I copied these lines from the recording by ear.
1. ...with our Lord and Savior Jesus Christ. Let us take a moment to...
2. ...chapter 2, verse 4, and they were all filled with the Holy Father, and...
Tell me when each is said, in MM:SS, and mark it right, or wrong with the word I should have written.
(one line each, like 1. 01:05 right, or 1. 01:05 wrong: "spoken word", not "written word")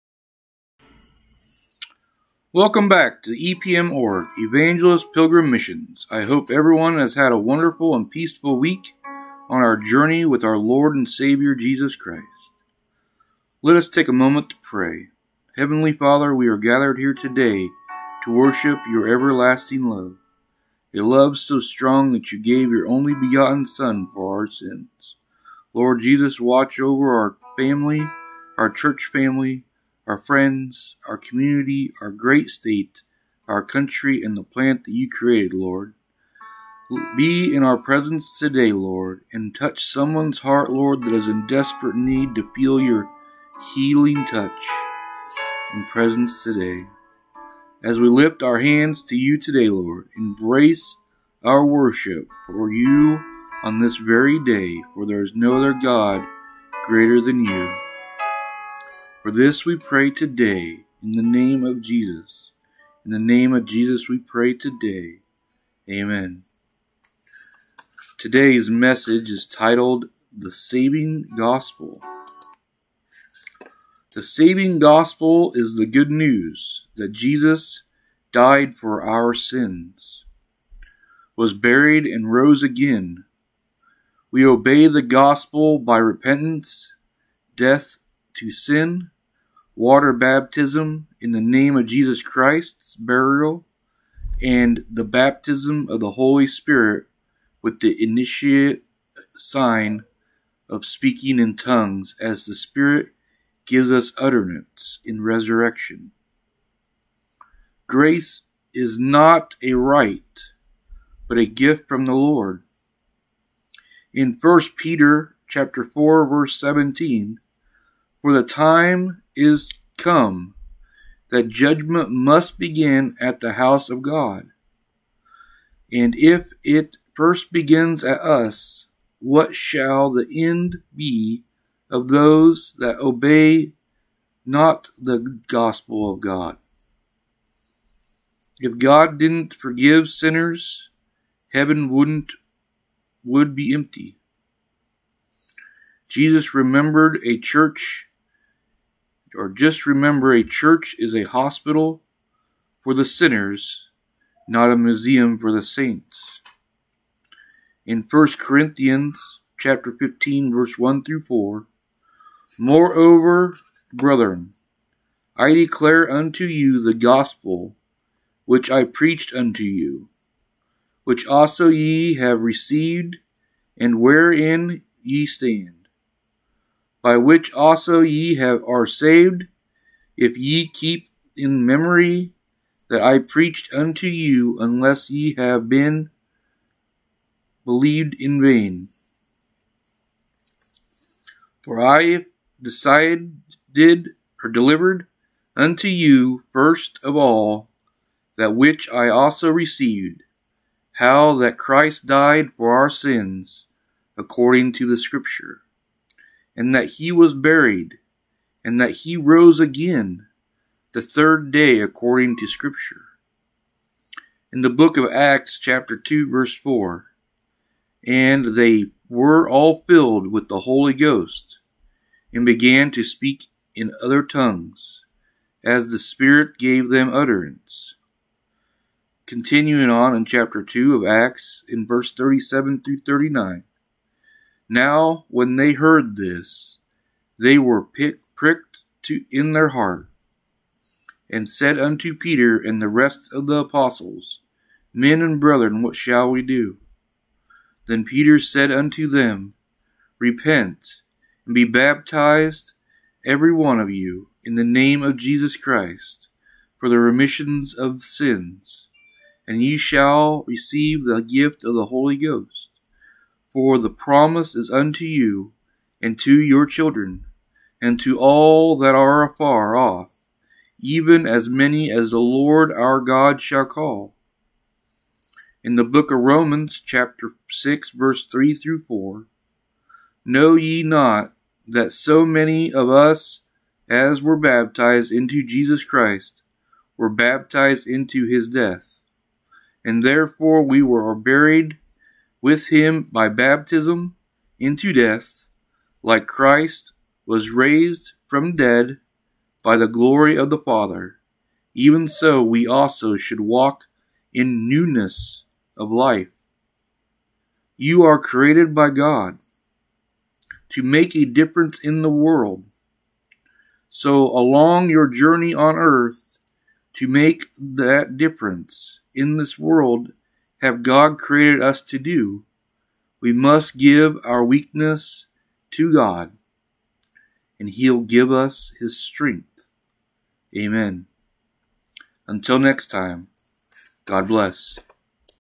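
1. 00:10 right
2. 03:35 wrong: "Ghost", not "Father".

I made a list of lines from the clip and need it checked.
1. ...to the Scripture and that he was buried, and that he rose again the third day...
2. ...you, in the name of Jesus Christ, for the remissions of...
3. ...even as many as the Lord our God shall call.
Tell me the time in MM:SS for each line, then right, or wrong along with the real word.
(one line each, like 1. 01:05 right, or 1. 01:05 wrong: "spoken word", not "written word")
1. 03:24 right
2. 04:13 right
3. 04:30 right.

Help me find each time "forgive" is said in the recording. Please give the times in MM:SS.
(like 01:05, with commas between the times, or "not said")
02:19.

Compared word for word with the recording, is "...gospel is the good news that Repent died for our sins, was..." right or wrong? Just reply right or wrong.
wrong.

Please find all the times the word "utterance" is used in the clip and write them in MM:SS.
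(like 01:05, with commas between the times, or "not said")
01:44, 03:47.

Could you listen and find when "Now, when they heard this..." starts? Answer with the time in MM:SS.
03:54.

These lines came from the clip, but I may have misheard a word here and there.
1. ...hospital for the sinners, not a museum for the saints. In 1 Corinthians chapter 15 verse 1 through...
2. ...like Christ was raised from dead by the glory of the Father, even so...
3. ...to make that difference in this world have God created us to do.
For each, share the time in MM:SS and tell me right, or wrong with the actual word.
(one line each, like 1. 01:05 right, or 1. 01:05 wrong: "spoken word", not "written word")
1. 02:31 right
2. 04:56 right
3. 05:16 right.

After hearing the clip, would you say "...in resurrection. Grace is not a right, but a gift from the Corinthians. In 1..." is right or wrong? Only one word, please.
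wrong.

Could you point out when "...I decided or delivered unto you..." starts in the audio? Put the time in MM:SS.
03:11.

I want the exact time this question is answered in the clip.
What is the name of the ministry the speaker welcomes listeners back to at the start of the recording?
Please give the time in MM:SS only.
00:03.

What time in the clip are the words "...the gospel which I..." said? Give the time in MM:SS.
02:46.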